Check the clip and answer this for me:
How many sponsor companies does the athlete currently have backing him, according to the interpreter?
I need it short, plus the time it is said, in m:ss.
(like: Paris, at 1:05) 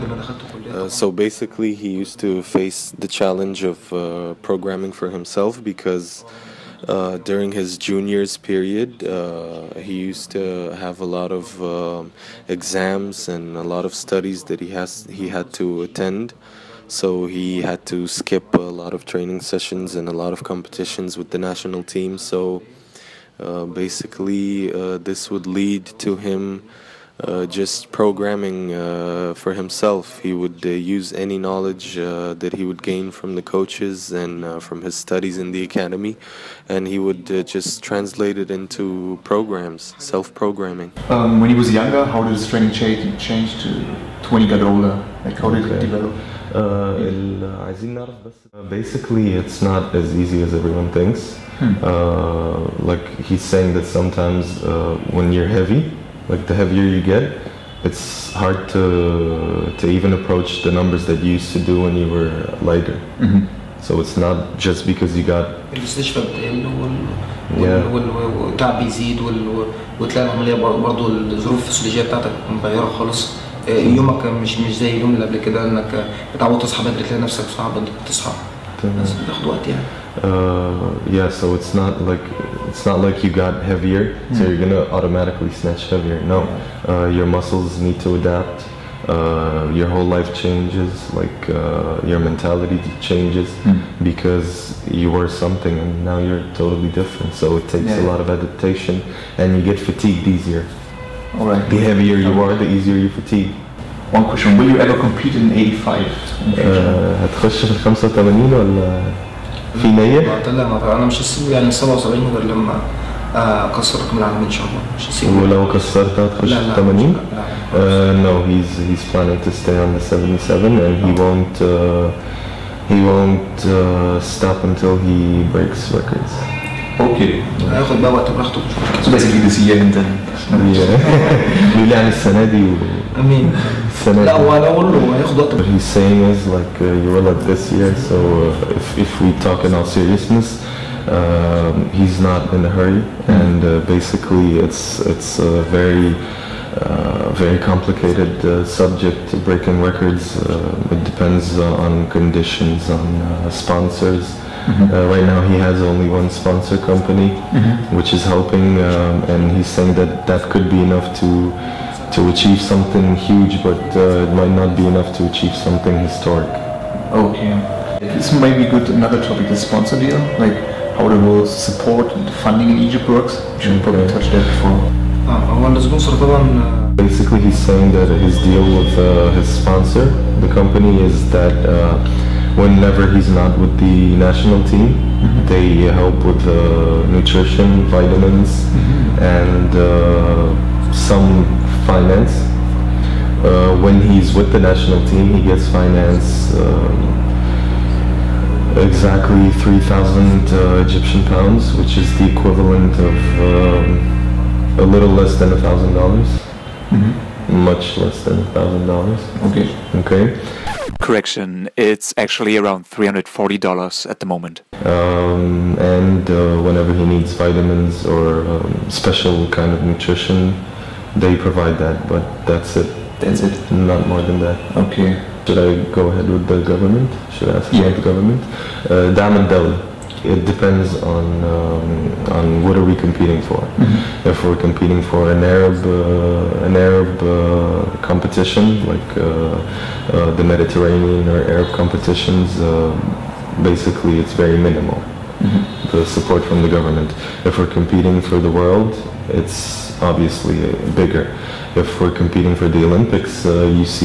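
1, at 2:35.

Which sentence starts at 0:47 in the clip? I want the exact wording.
عايزين نعرف بس basically it's not as easy as everyone thinks hmm.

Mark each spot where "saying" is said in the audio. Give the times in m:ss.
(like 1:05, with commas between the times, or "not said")
0:53, 2:15, 2:39, 2:57.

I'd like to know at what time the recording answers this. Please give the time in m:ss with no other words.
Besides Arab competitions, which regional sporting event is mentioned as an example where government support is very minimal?
4:00.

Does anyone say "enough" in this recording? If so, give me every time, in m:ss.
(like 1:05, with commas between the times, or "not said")
2:40, 2:44.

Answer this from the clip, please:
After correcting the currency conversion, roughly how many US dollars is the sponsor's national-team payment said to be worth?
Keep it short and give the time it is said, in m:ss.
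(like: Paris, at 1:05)
$340, at 3:32.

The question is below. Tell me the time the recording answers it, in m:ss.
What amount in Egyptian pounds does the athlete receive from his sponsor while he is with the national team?
3:19.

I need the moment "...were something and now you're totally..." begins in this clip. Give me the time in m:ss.
1:35.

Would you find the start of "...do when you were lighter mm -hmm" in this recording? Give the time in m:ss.
1:01.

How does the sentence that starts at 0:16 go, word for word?
So he had to skip a lot of training sessions and a lot of competitions with the national team.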